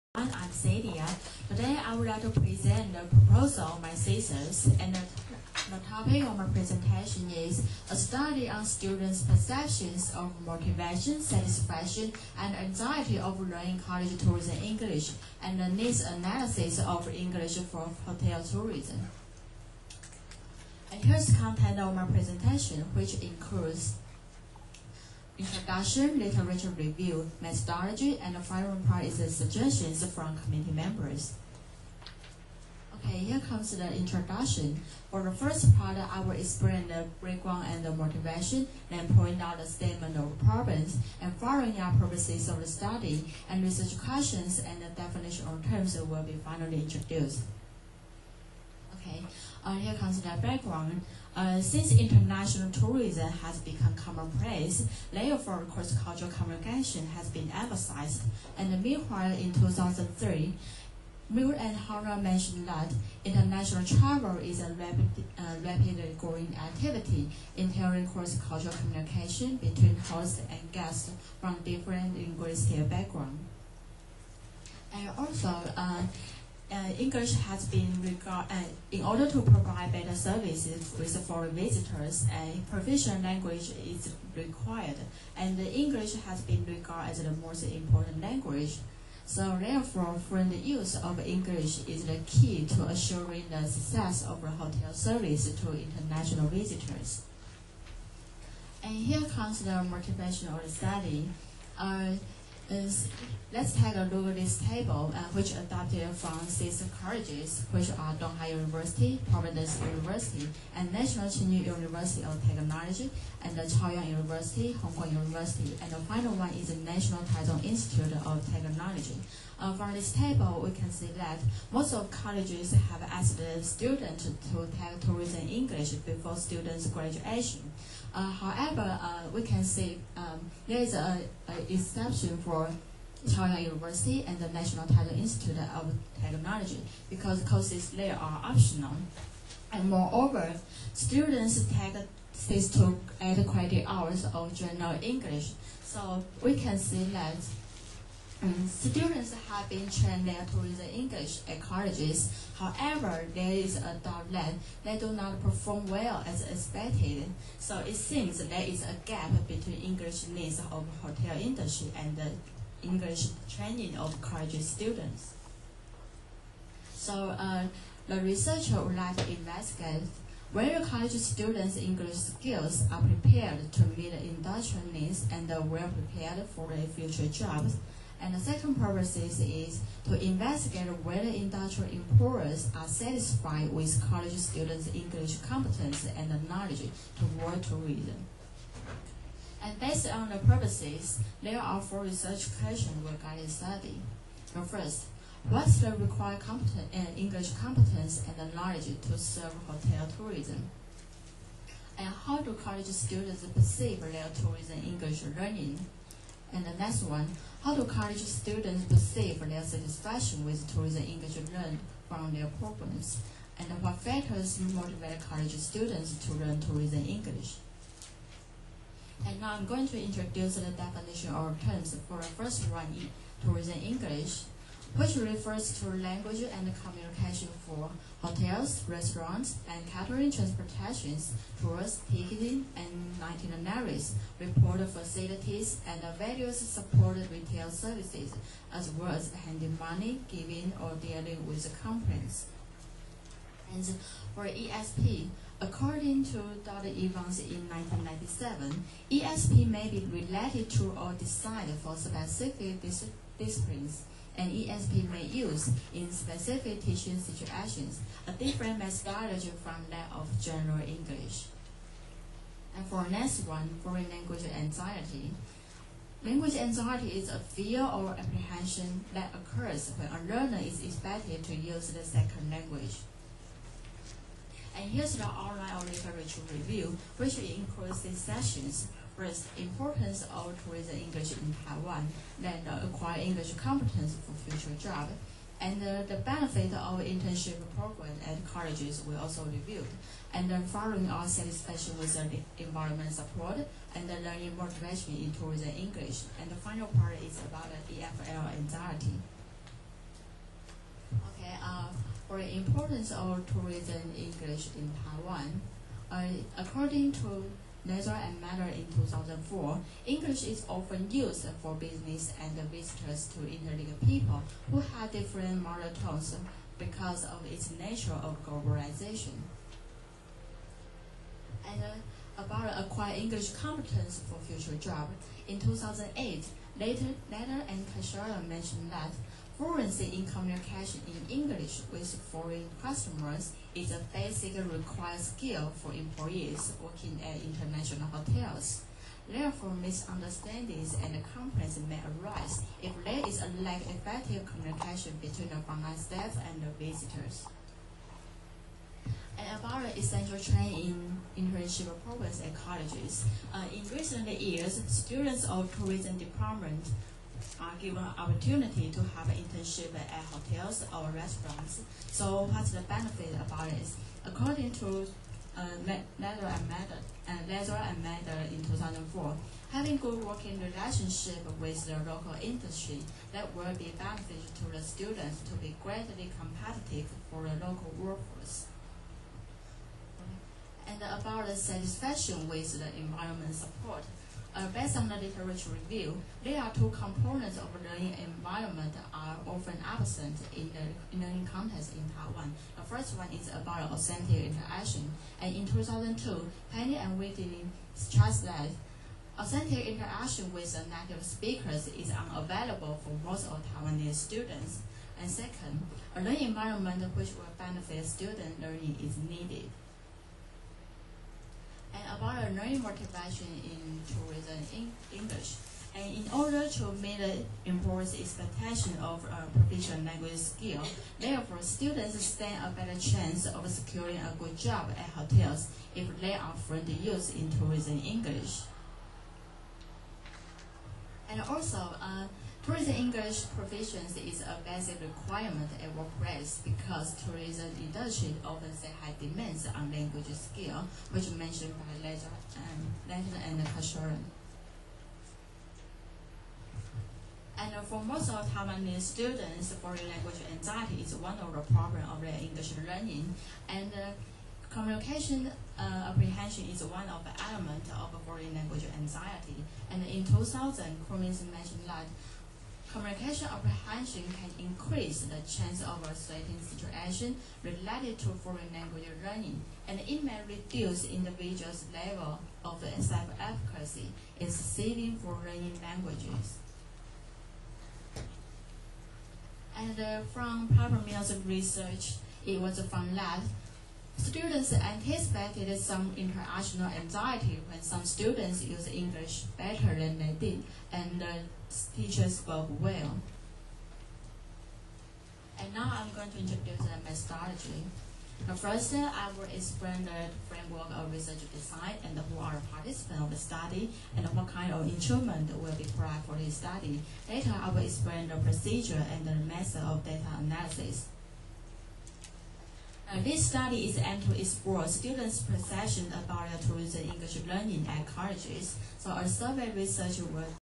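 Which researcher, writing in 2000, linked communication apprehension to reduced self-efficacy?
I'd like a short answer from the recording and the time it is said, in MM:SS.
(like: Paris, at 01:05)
Cummings, at 07:41.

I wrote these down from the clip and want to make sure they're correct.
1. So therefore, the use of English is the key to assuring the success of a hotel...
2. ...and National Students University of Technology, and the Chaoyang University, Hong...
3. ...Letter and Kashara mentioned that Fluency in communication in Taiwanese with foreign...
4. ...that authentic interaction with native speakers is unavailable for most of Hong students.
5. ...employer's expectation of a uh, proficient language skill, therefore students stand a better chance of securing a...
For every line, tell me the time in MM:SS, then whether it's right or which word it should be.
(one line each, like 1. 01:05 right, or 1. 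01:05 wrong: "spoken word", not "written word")
1. 01:29 right
2. 01:50 wrong: "Tsinghua", not "Students"
3. 05:27 wrong: "English", not "Taiwanese"
4. 06:38 wrong: "Taiwanese", not "Hong"
5. 06:57 right.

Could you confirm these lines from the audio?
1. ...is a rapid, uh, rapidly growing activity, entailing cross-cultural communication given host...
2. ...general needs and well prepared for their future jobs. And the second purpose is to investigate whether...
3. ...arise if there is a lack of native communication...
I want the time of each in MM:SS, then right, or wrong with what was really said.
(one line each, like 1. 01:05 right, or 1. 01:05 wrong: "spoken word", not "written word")
1. 01:04 wrong: "between", not "given"
2. 02:54 wrong: "industrial", not "general"
3. 05:42 wrong: "effective", not "native".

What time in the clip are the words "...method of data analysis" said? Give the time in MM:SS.
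08:29.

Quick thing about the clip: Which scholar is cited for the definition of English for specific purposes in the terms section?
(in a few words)
Dudley-Evans.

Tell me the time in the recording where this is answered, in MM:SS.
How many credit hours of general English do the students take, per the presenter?
02:22.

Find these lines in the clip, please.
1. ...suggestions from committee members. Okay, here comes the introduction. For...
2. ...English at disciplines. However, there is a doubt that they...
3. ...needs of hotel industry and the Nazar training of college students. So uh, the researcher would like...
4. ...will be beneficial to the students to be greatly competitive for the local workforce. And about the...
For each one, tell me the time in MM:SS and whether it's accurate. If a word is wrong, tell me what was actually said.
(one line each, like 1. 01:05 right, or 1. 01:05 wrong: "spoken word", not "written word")
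1. 00:29 right
2. 02:30 wrong: "colleges", not "disciplines"
3. 02:40 wrong: "English", not "Nazar"
4. 06:13 right.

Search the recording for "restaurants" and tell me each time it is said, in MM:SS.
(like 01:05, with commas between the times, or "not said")
03:48, 06:01.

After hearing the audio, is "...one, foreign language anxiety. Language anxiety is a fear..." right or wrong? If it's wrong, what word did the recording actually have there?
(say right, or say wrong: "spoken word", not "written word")
right.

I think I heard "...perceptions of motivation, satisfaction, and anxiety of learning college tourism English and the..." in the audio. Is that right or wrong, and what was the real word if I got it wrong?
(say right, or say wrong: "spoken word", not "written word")
right.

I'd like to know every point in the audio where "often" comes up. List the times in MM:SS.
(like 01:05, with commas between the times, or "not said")
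05:10, 06:29, 07:18.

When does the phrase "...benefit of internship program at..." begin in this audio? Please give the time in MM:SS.
04:46.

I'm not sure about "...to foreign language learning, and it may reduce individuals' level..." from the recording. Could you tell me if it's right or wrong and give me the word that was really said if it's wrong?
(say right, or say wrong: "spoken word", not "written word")
right.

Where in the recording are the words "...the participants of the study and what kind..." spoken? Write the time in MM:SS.
08:22.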